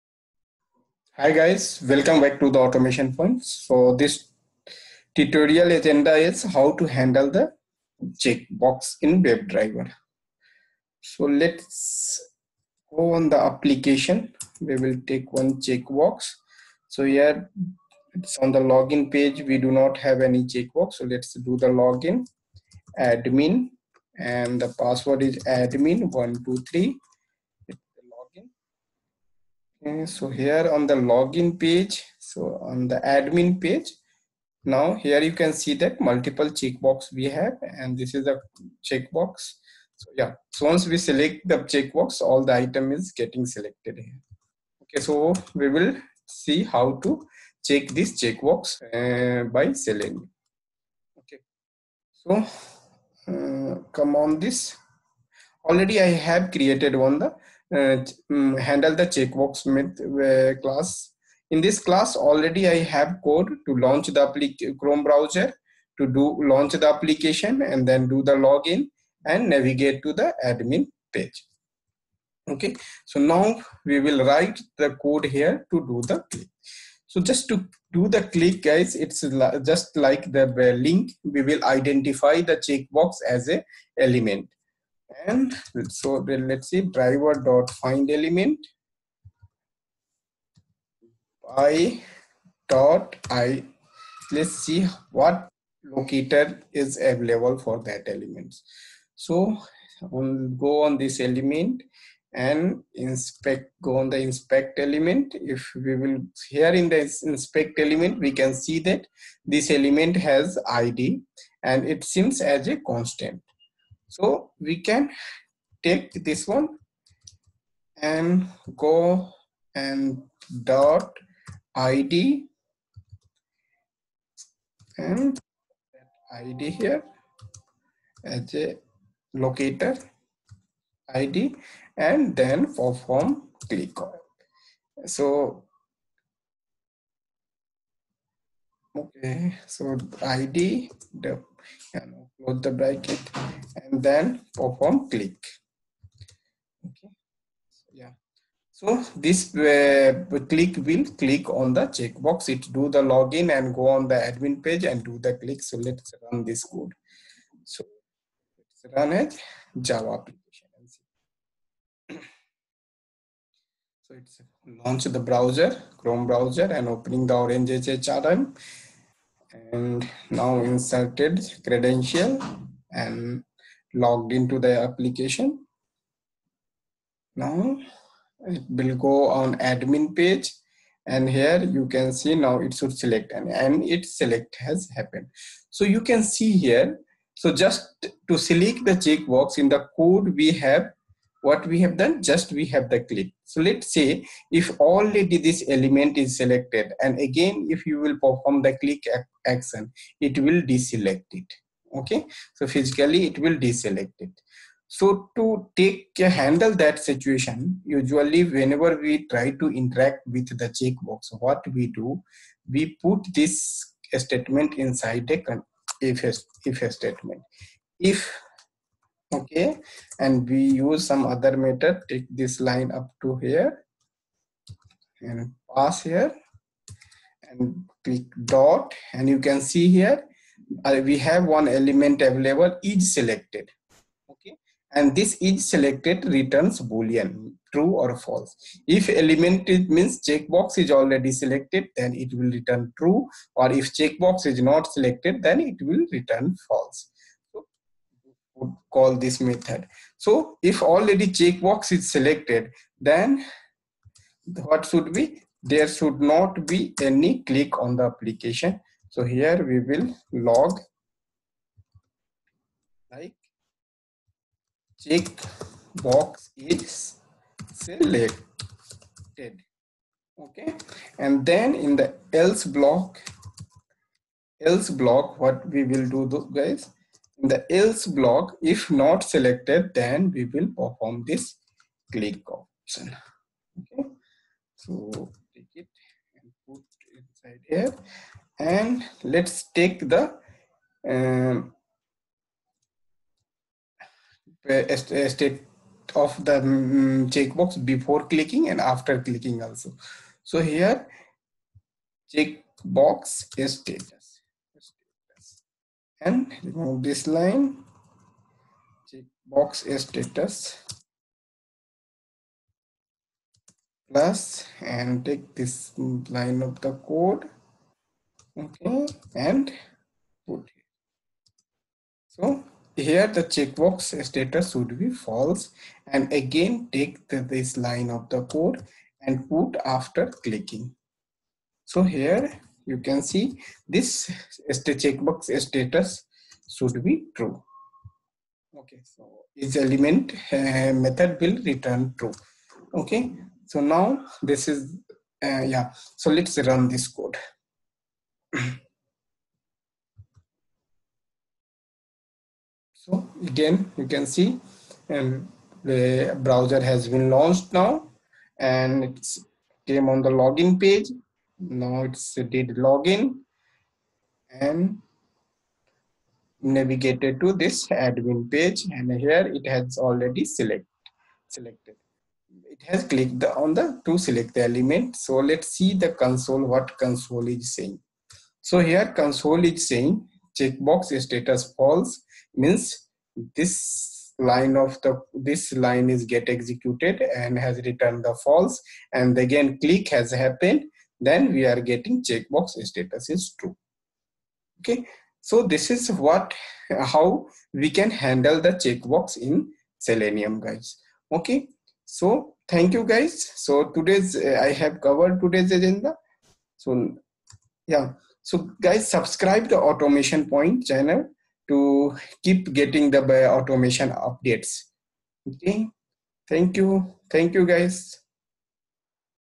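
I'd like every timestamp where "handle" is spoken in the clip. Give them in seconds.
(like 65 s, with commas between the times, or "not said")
6 s, 58 s, 206 s, 398 s.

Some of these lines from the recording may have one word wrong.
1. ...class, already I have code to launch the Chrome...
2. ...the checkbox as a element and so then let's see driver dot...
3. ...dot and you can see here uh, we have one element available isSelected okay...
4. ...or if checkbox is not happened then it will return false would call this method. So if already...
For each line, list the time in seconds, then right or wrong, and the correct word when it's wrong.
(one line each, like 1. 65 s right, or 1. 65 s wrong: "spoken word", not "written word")
1. 61 s right
2. 82 s right
3. 228 s right
4. 243 s wrong: "selected", not "happened".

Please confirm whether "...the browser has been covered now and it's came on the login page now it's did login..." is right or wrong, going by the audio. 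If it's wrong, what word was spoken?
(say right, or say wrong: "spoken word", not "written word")
wrong: "launched", not "covered".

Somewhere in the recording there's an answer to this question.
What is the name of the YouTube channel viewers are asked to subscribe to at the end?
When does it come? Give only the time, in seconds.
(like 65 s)
409 s.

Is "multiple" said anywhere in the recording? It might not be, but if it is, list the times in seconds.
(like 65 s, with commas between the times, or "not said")
35 s.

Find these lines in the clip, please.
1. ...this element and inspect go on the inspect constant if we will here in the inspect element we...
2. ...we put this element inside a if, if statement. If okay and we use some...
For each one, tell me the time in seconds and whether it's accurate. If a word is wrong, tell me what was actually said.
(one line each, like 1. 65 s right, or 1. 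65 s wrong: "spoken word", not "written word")
1. 100 s wrong: "element", not "constant"
2. 212 s wrong: "statement", not "element".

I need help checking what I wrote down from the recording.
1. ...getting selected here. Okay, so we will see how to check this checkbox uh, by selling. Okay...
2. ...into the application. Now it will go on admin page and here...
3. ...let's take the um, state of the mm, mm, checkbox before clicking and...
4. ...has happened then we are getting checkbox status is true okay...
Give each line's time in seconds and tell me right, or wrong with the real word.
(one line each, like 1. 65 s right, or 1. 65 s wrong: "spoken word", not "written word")
1. 43 s right
2. 174 s right
3. 289 s right
4. 390 s right.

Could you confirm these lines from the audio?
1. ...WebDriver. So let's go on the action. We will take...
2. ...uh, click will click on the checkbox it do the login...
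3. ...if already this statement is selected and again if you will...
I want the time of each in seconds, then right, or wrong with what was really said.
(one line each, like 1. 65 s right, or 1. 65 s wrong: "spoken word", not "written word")
1. 9 s wrong: "application", not "action"
2. 149 s right
3. 194 s wrong: "element", not "statement".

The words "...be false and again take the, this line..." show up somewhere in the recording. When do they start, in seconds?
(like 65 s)
325 s.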